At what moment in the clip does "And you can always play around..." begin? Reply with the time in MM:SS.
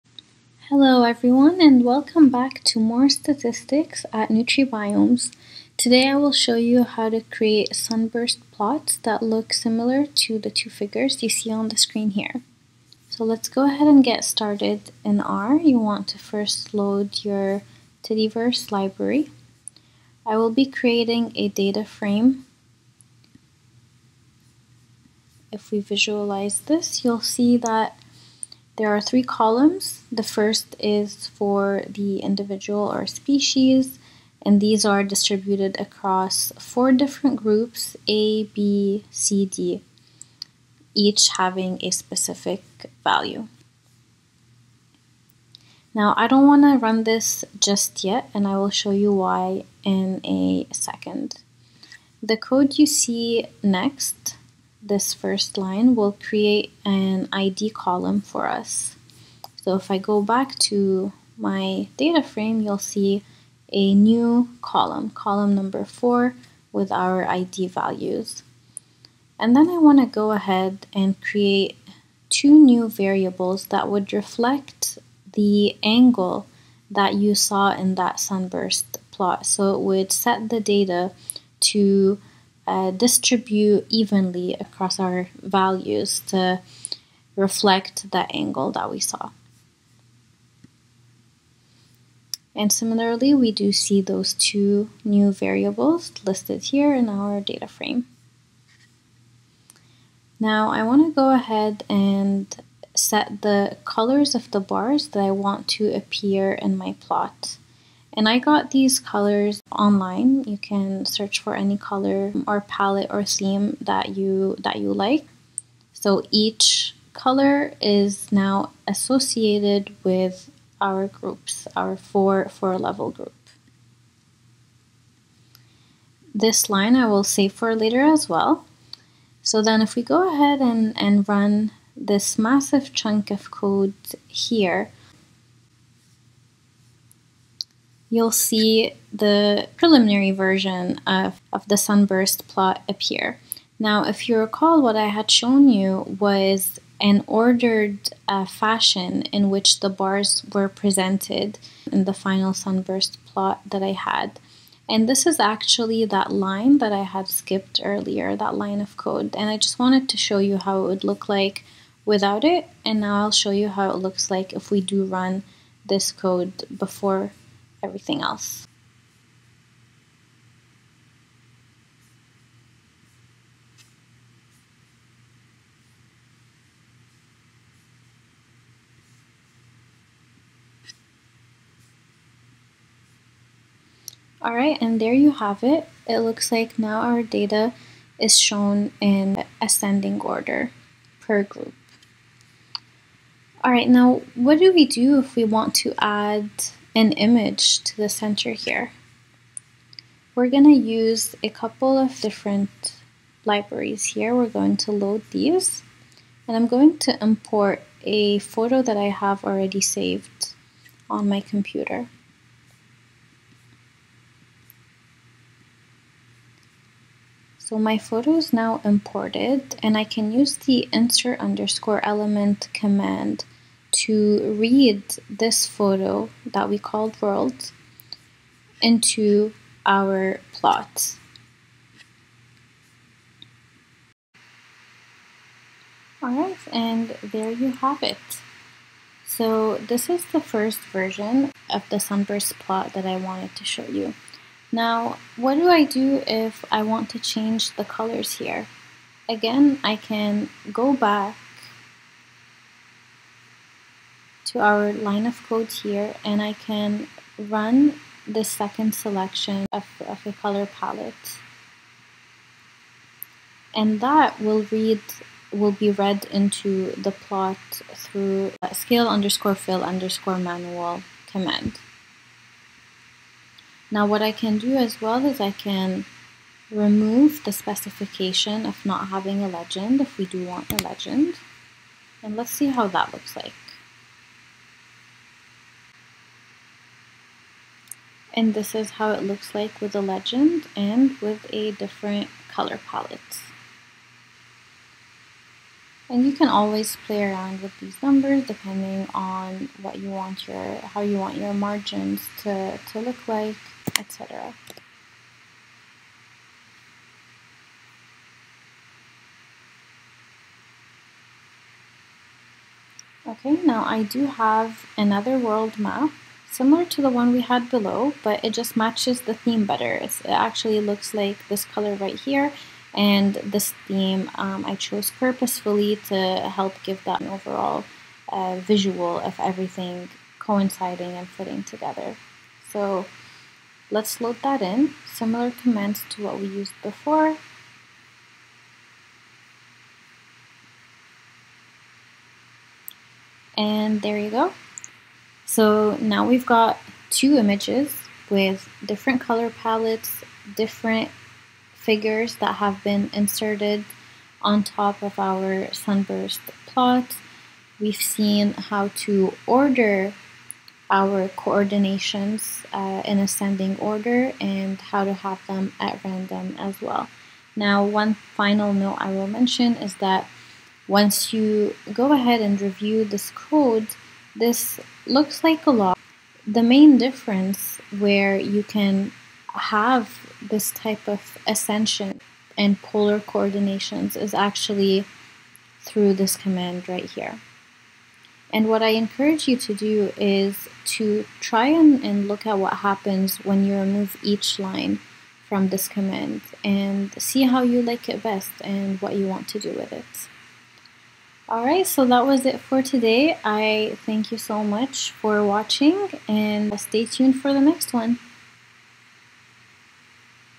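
04:56.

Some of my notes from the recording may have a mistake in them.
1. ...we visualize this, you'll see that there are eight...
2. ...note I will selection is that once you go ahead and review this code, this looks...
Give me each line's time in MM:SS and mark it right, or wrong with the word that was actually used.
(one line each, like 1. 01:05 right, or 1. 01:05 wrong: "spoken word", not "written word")
1. 00:25 wrong: "three", not "eight"
2. 06:08 wrong: "mention", not "selection".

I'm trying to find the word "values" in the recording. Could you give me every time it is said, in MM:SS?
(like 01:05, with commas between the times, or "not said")
00:43, 01:07, 01:25.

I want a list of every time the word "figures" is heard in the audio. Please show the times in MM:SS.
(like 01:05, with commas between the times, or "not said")
00:10, 05:51.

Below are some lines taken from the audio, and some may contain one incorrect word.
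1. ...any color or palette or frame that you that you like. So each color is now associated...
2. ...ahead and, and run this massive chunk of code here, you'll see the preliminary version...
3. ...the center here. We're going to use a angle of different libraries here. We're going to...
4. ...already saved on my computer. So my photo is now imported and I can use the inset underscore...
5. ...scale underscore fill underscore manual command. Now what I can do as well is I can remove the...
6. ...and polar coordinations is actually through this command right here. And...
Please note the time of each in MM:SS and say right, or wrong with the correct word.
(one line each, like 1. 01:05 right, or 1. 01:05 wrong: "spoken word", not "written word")
1. 01:51 wrong: "theme", not "frame"
2. 02:10 right
3. 03:17 wrong: "couple", not "angle"
4. 03:29 right
5. 04:28 right
6. 06:22 right.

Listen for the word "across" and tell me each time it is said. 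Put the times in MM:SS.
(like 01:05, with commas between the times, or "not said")
00:35, 01:24.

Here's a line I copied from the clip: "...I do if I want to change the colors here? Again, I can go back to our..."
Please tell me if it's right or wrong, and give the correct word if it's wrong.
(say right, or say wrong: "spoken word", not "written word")
right.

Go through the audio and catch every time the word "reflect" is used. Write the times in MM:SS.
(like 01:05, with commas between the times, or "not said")
01:14, 01:27.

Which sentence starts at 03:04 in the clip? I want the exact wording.
All right, and there you have it.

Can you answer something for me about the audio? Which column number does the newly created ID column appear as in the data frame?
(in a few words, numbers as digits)
4.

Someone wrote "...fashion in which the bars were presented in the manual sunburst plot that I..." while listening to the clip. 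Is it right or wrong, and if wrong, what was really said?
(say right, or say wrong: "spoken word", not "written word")
wrong: "final", not "manual".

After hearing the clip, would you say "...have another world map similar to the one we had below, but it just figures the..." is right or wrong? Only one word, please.
wrong.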